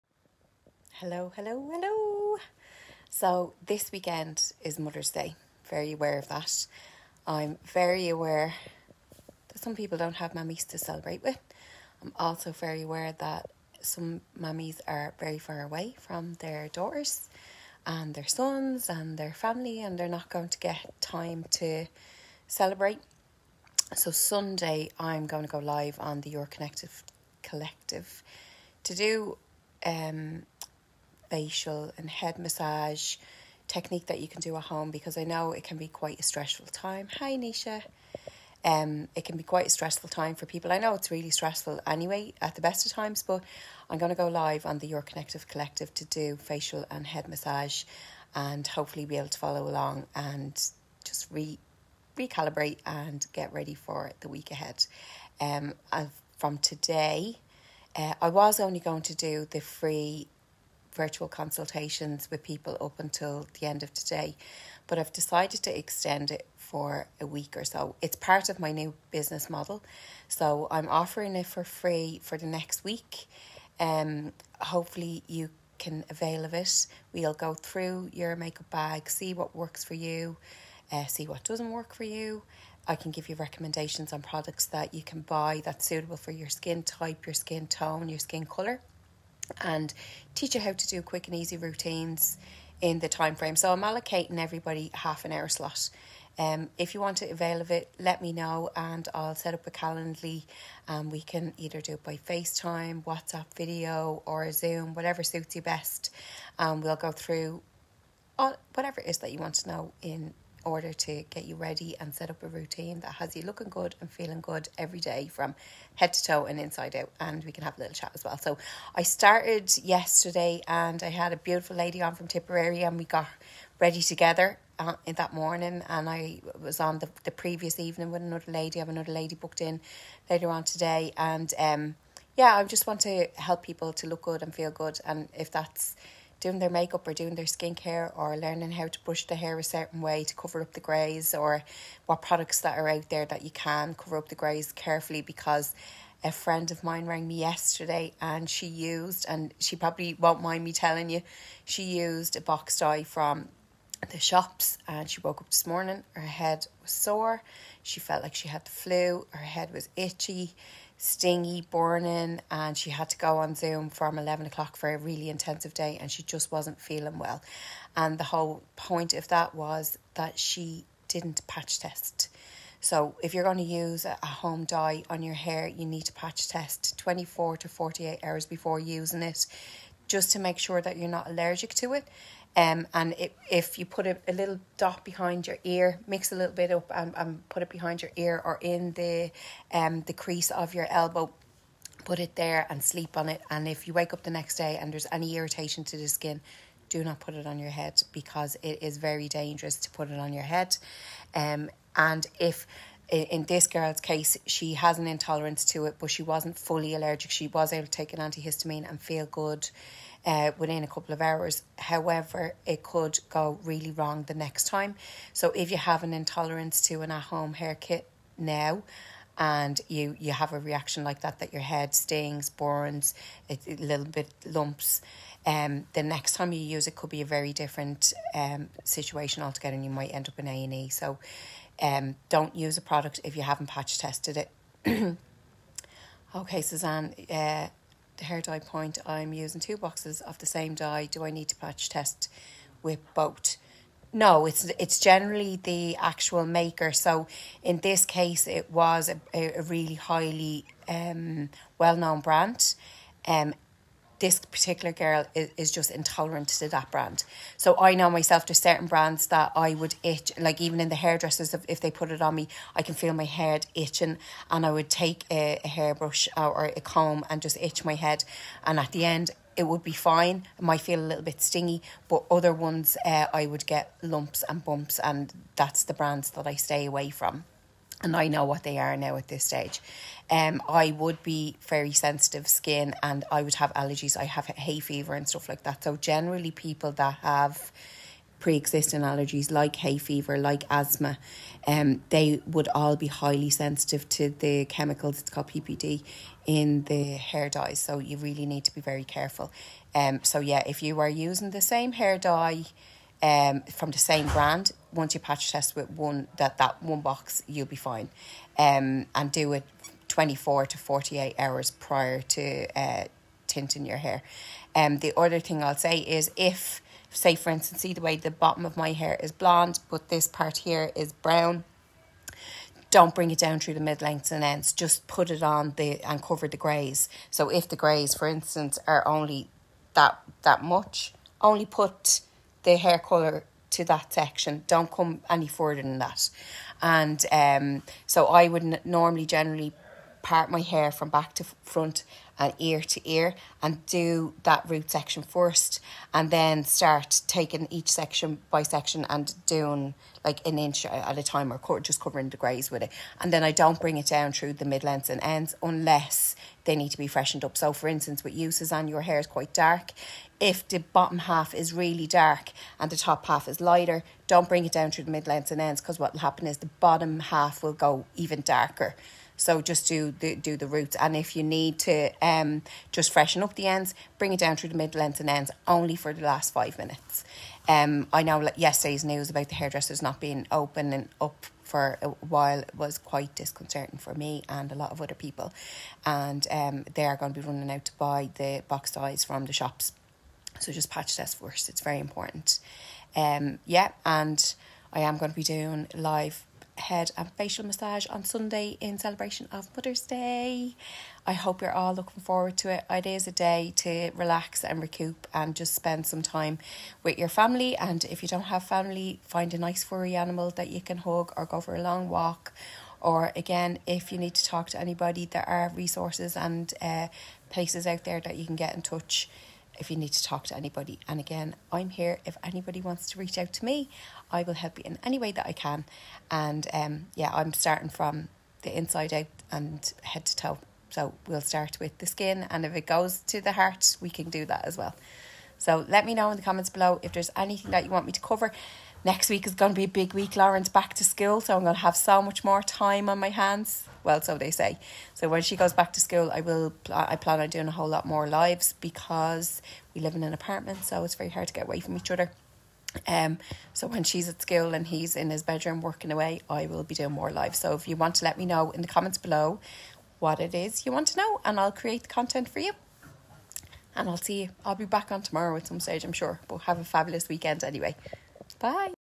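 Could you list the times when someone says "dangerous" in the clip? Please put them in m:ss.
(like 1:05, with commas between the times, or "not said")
3:19.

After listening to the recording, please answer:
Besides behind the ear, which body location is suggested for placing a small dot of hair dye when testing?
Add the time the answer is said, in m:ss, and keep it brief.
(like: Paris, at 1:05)
Crease of your elbow, at 3:10.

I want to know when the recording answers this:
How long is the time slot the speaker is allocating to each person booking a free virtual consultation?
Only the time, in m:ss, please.
1:34.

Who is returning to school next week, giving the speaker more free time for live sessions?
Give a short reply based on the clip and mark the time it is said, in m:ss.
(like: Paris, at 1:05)
Lauren, at 7:20.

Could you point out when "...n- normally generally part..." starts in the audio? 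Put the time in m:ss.
5:38.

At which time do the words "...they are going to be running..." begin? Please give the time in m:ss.
6:26.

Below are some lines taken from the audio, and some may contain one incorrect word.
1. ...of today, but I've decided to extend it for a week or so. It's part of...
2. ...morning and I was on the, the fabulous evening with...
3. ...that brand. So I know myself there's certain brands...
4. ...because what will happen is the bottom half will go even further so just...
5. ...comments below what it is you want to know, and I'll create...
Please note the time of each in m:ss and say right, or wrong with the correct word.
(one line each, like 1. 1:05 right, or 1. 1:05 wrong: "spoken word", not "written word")
1. 1:03 right
2. 2:05 wrong: "previous", not "fabulous"
3. 4:16 right
4. 6:05 wrong: "darker", not "further"
5. 7:38 right.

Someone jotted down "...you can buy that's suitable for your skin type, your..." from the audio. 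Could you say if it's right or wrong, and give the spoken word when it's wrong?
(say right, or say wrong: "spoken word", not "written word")
right.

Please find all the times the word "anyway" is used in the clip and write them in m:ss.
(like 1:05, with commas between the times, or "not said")
0:41, 7:47.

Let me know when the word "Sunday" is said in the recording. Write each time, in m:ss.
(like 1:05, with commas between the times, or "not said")
0:24, 6:38.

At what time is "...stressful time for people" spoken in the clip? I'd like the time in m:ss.
0:39.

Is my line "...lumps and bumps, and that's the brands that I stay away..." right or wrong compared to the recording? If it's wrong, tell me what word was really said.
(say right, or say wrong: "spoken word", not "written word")
right.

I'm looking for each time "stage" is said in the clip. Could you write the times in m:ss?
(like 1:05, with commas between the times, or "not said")
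4:39, 7:45.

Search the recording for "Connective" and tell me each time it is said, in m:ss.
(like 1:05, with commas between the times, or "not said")
0:26, 0:45.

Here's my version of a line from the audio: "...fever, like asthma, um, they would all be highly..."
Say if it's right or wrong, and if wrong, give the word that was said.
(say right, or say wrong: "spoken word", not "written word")
right.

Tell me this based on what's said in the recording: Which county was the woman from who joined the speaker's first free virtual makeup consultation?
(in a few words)
Tipperary.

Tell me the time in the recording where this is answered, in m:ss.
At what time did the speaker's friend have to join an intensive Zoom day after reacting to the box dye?
2:44.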